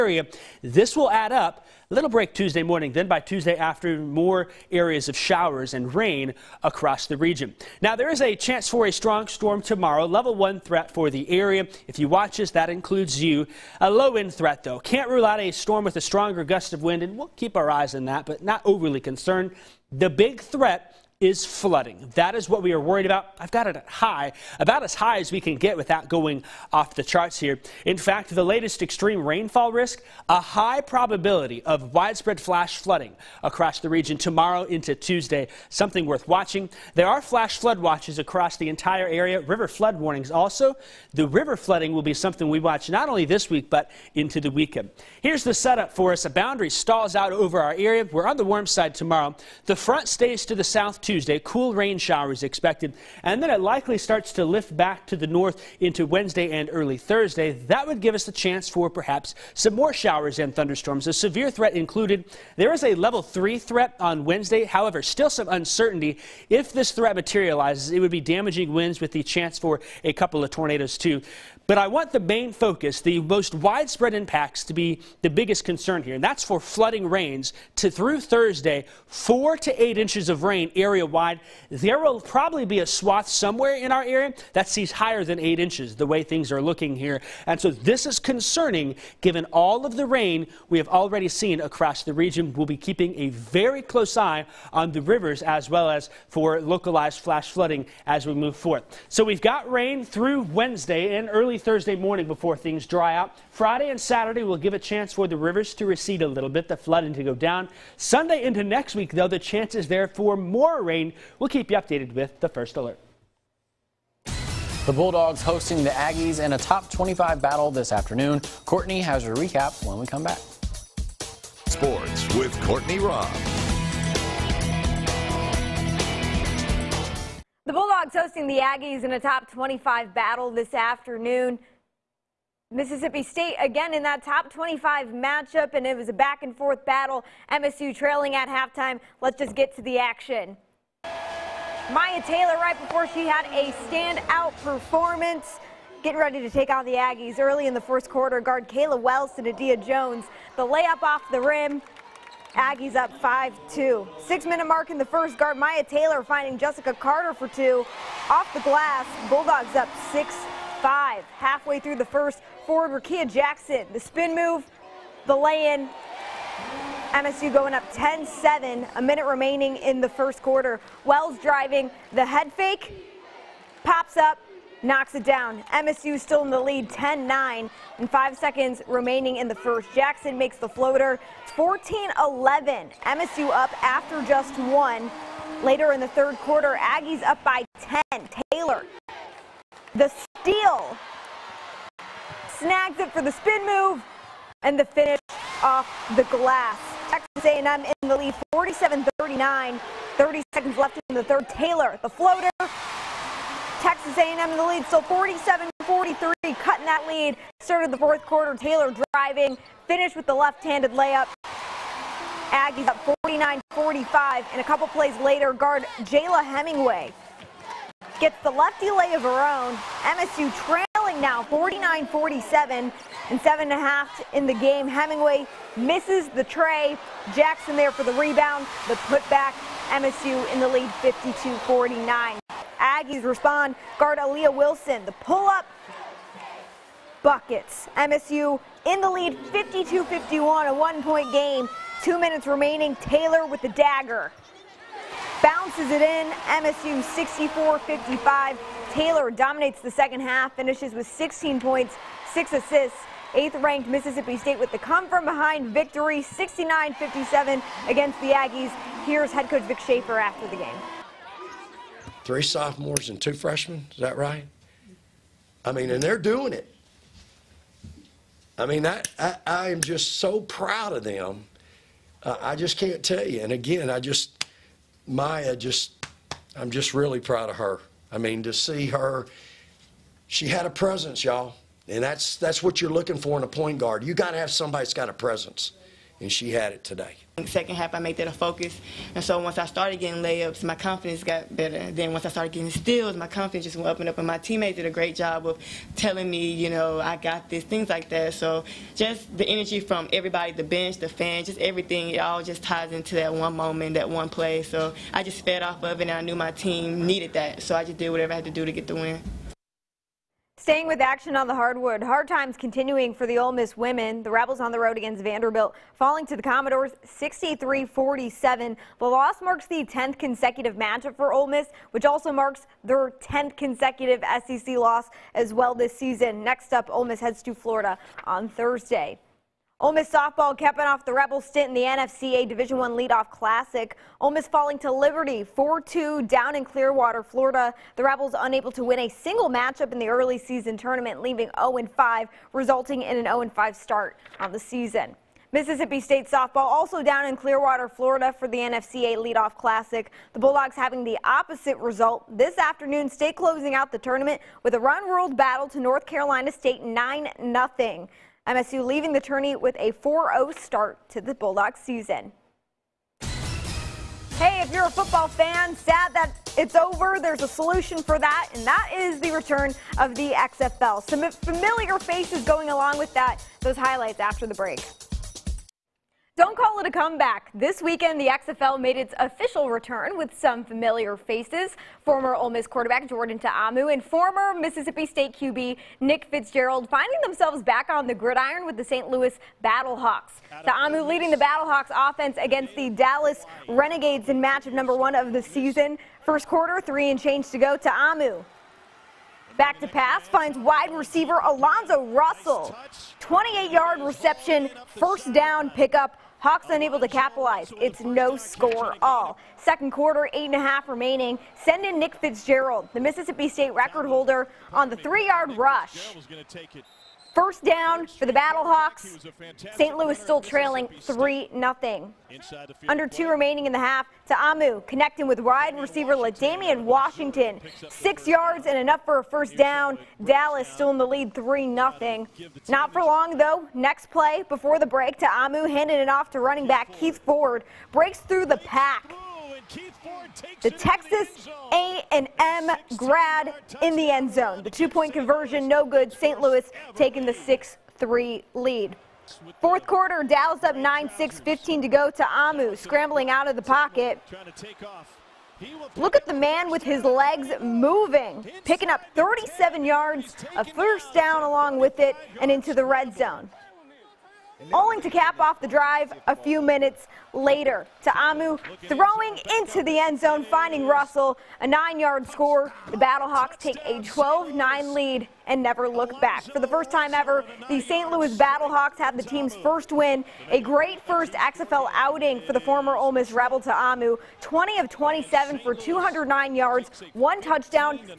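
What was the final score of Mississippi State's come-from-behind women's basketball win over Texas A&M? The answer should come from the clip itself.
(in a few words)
69-57.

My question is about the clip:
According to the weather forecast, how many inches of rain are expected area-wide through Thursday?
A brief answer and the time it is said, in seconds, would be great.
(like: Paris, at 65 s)
4 to 8 inches, at 79 s.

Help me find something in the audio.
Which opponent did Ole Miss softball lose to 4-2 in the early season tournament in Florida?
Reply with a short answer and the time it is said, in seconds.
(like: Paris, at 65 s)
Liberty, at 334 s.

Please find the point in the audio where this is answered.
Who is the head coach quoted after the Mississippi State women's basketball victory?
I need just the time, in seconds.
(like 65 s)
259 s.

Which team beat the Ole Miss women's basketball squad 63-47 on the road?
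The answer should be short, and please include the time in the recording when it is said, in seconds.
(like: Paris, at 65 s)
Vanderbilt, at 315 s.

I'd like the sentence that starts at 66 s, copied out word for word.
If this threat materializes, it would be damaging winds with the chance for a couple of tornadoes too.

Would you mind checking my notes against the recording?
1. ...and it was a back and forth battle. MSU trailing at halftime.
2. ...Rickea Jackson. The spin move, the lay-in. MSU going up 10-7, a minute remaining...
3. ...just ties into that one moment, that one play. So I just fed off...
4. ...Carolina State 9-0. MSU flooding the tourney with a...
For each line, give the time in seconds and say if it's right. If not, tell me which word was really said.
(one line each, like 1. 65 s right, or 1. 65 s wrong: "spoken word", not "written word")
1. 135 s right
2. 163 s right
3. 302 s right
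4. 356 s wrong: "leaving", not "flooding".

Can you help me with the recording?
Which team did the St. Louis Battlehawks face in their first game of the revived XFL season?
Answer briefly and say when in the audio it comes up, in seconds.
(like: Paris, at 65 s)
Dallas Renegades, at 392 s.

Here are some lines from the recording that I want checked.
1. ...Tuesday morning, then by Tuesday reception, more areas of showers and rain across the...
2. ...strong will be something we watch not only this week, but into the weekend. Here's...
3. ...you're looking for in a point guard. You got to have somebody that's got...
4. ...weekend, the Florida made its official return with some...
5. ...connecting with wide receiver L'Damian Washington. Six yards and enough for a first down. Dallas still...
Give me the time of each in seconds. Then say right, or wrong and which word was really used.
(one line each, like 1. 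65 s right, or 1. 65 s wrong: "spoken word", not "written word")
1. 2 s wrong: "afternoon", not "reception"
2. 41 s wrong: "flooding", not "strong"
3. 282 s right
4. 377 s wrong: "XFL", not "Florida"
5. 424 s right.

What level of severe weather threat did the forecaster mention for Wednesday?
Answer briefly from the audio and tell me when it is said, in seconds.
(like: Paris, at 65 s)
Level 3, at 62 s.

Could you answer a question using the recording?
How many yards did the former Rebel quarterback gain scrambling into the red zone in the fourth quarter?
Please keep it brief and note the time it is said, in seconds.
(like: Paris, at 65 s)
37, at 459 s.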